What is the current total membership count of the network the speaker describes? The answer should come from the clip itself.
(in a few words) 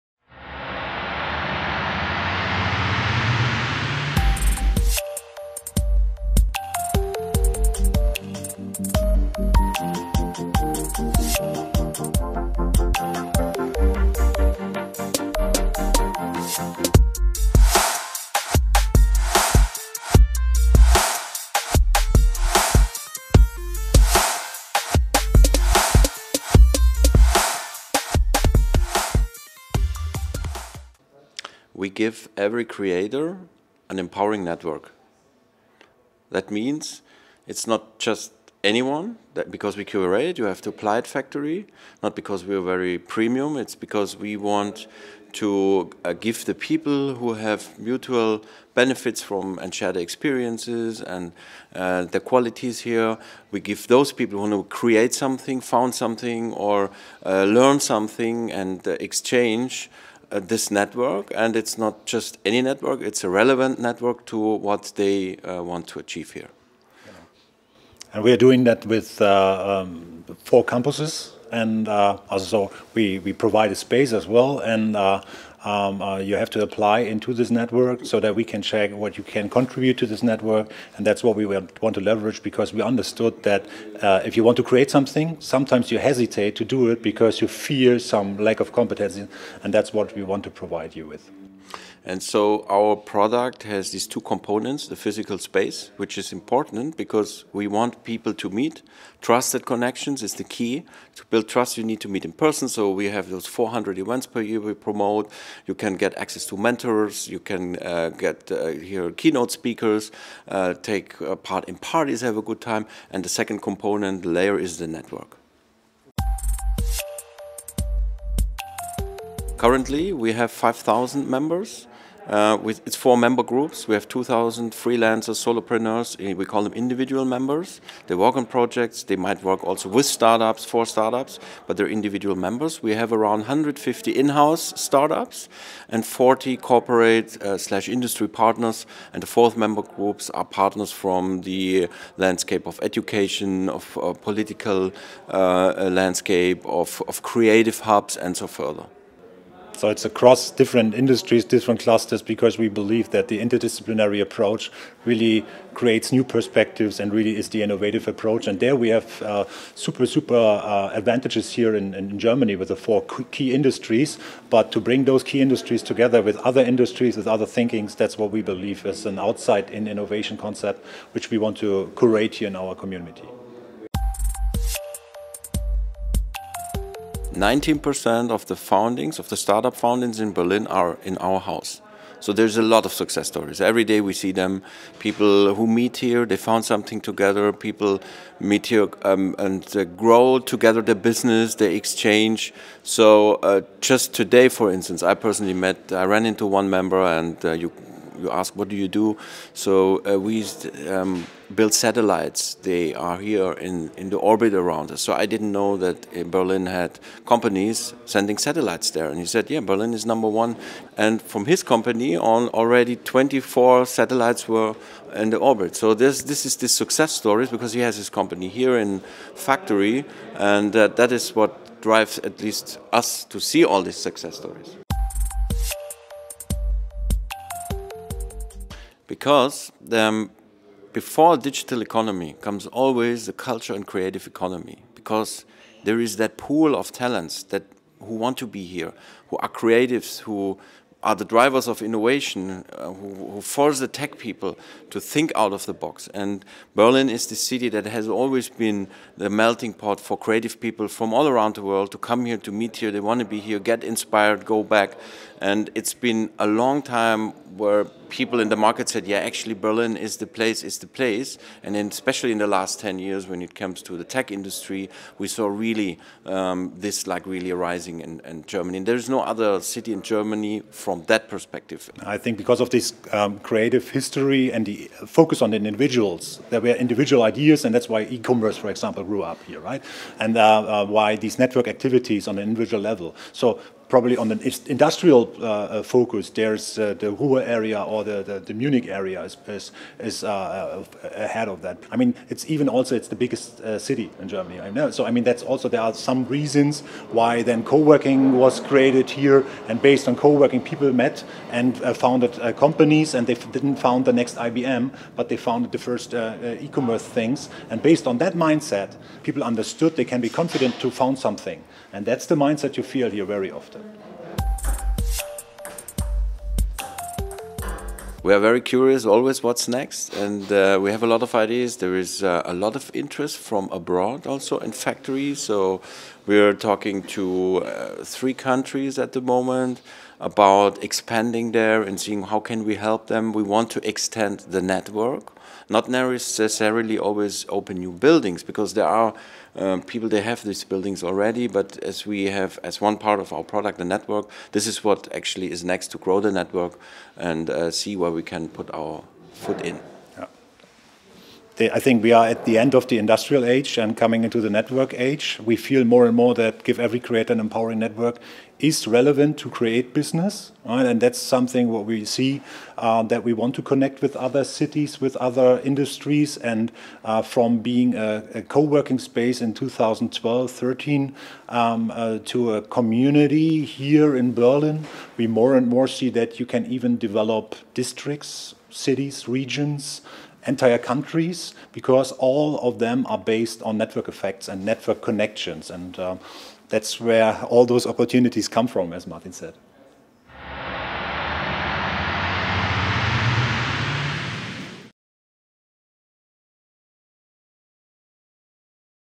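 5,000.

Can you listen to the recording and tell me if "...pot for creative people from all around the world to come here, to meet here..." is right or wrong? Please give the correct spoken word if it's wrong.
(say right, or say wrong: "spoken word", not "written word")
right.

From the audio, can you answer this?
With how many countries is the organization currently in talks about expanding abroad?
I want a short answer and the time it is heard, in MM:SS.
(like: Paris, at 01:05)
3, at 05:28.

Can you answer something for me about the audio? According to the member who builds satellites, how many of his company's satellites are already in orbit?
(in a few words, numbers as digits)
24.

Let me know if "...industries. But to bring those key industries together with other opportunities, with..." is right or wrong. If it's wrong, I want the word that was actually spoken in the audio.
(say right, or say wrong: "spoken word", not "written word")
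wrong: "industries", not "opportunities".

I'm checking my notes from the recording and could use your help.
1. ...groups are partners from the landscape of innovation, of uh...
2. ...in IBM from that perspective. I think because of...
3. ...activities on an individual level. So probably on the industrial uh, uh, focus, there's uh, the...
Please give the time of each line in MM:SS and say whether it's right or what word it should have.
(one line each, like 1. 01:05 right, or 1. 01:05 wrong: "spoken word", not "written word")
1. 02:19 wrong: "education", not "innovation"
2. 04:29 wrong: "Germany", not "IBM"
3. 04:41 right.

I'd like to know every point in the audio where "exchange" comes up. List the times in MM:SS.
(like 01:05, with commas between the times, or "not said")
00:58, 03:11.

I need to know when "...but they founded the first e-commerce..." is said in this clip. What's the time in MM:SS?
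05:05.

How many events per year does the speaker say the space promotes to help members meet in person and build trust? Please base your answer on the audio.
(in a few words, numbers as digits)
400.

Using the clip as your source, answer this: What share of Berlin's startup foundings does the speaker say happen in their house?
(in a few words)
19%.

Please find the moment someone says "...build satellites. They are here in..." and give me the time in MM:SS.
03:21.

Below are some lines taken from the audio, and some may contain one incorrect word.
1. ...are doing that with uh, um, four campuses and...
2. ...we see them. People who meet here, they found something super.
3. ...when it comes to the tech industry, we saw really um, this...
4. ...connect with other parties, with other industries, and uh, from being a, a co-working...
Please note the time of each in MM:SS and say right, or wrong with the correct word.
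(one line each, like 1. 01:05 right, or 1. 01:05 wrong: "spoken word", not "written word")
1. 01:08 right
2. 03:04 wrong: "together", not "super"
3. 04:23 right
4. 06:03 wrong: "cities", not "parties".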